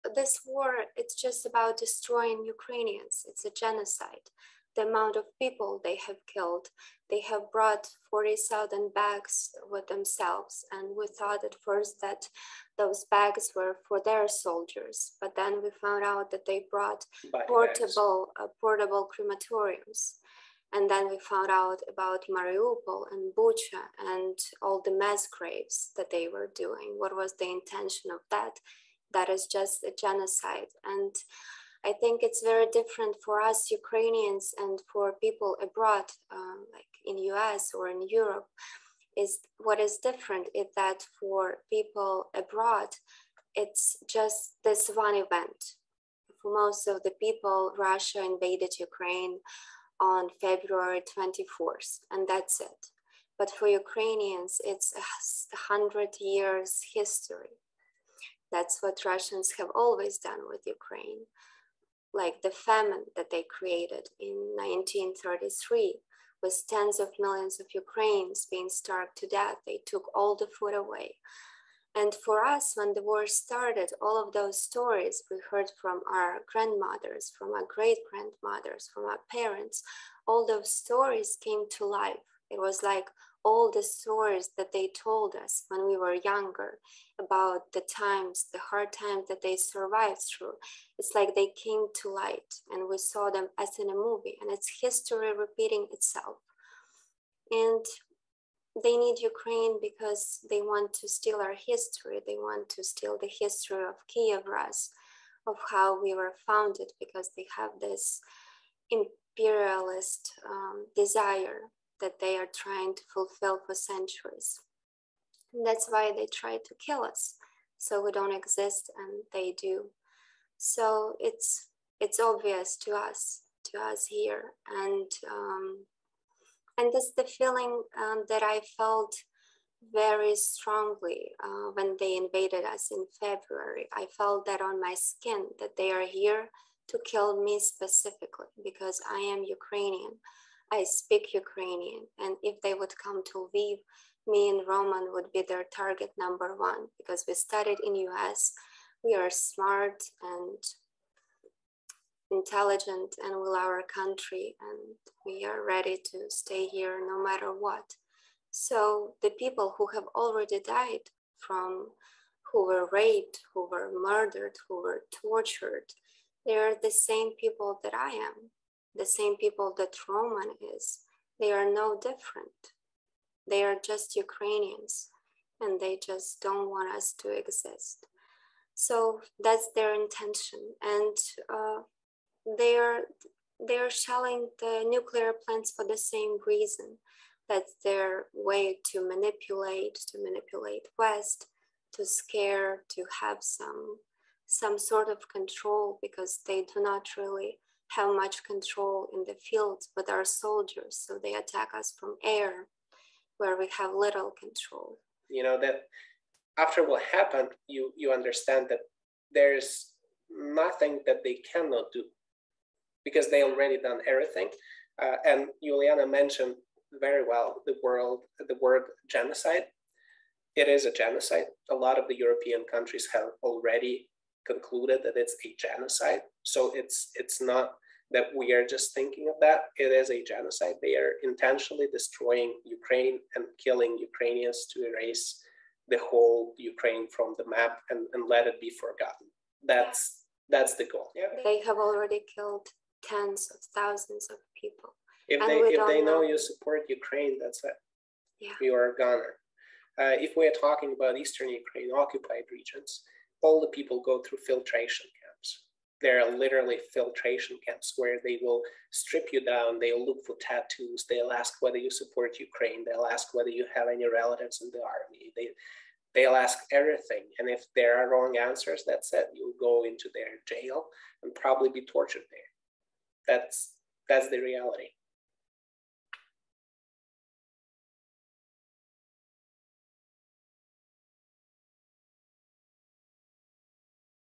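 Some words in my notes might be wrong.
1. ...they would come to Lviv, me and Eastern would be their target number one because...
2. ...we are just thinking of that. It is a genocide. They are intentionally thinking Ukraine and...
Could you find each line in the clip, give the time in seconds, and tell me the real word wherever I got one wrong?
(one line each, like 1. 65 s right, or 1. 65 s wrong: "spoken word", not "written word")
1. 142 s wrong: "Roman", not "Eastern"
2. 228 s wrong: "destroying", not "thinking".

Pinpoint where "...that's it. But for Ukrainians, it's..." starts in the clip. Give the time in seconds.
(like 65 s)
52 s.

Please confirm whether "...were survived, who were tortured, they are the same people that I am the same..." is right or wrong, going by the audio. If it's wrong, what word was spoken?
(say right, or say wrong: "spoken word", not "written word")
wrong: "murdered", not "survived".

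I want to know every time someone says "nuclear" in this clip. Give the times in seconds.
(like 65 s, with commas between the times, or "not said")
184 s.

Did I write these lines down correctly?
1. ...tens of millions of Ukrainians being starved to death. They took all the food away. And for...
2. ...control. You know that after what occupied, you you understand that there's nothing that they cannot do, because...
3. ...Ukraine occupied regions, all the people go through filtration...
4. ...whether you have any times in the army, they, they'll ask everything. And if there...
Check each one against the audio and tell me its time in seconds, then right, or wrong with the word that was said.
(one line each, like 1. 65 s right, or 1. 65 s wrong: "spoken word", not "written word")
1. 66 s right
2. 204 s wrong: "happened", not "occupied"
3. 251 s right
4. 263 s wrong: "relatives", not "times".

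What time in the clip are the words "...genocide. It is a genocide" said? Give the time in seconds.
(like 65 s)
219 s.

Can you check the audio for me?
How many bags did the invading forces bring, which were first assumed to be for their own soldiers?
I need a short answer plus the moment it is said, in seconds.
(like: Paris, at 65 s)
40,000, at 8 s.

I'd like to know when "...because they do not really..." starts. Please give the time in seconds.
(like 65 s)
196 s.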